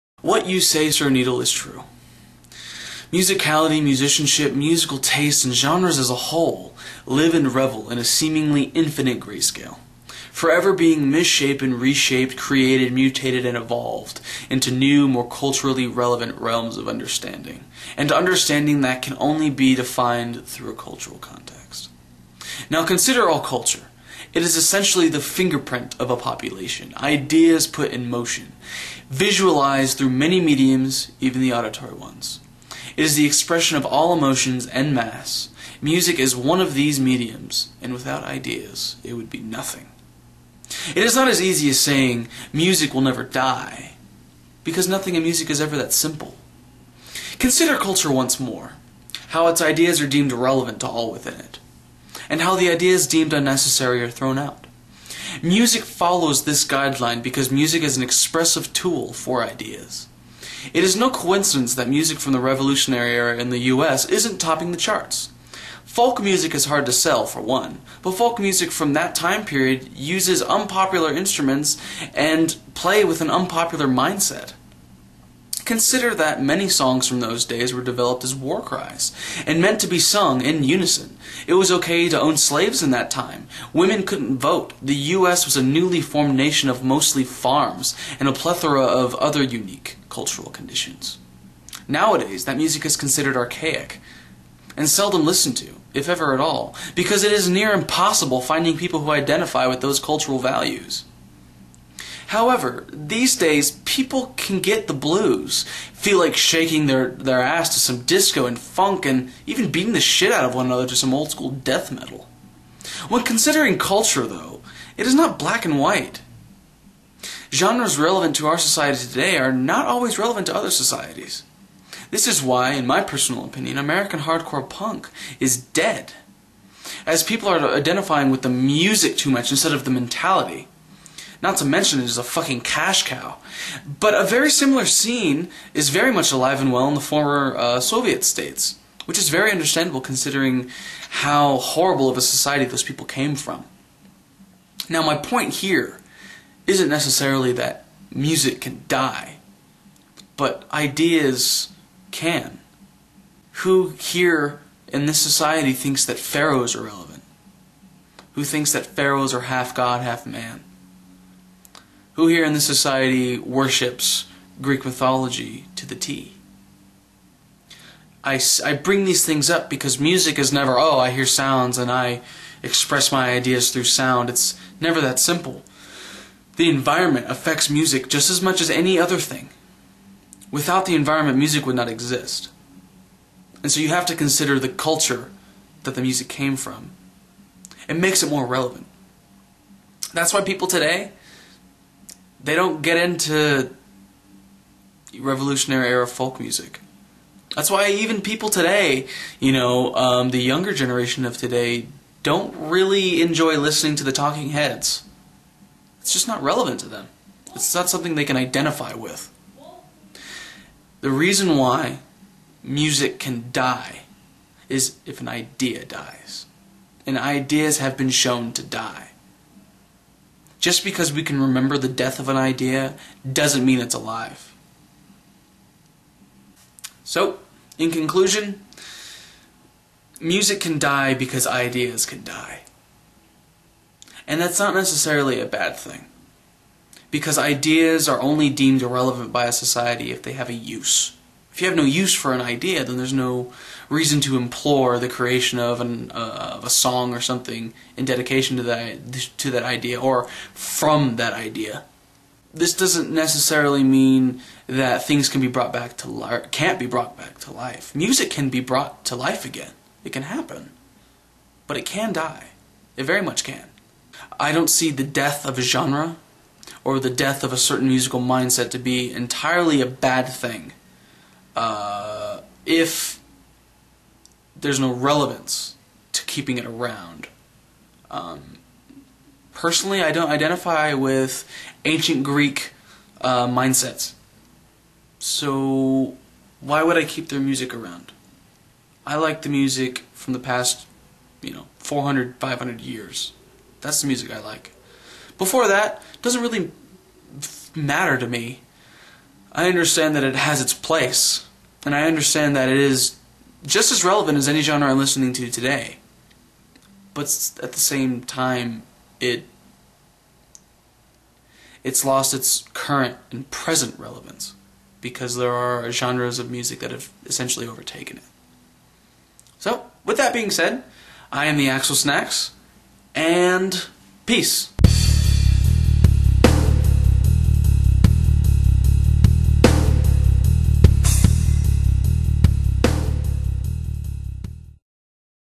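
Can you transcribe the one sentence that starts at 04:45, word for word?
So, why would I keep their music around?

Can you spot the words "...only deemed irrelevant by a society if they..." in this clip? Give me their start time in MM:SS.
03:58.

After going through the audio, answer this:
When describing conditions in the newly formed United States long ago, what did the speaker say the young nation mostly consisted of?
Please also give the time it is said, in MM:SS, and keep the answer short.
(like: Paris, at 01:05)
Farms, at 01:27.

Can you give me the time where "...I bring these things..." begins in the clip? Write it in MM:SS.
02:48.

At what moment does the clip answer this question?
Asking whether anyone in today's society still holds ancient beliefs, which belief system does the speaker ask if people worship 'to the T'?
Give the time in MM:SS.
02:44.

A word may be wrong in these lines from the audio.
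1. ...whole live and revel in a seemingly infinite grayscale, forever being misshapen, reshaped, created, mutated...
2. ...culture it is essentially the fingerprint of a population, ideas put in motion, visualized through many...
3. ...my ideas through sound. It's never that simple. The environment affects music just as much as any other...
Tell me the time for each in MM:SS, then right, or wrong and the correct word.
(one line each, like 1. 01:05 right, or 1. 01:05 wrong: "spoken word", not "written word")
1. 00:06 right
2. 00:23 right
3. 02:53 right.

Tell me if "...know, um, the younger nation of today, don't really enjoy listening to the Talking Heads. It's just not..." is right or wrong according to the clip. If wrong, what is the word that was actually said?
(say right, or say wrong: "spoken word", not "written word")
wrong: "generation", not "nation".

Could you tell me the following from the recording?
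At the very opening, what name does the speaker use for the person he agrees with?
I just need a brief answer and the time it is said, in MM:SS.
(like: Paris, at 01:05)
Sir Needle, at 00:00.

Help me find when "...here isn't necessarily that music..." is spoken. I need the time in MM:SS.
02:25.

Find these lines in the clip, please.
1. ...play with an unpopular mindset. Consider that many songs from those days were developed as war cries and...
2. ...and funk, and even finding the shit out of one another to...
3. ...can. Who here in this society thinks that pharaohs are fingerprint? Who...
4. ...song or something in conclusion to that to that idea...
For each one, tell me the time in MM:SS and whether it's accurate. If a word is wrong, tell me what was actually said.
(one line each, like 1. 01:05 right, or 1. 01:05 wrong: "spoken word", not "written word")
1. 01:12 right
2. 01:48 wrong: "beating", not "finding"
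3. 02:32 wrong: "relevant", not "fingerprint"
4. 04:06 wrong: "dedication", not "conclusion".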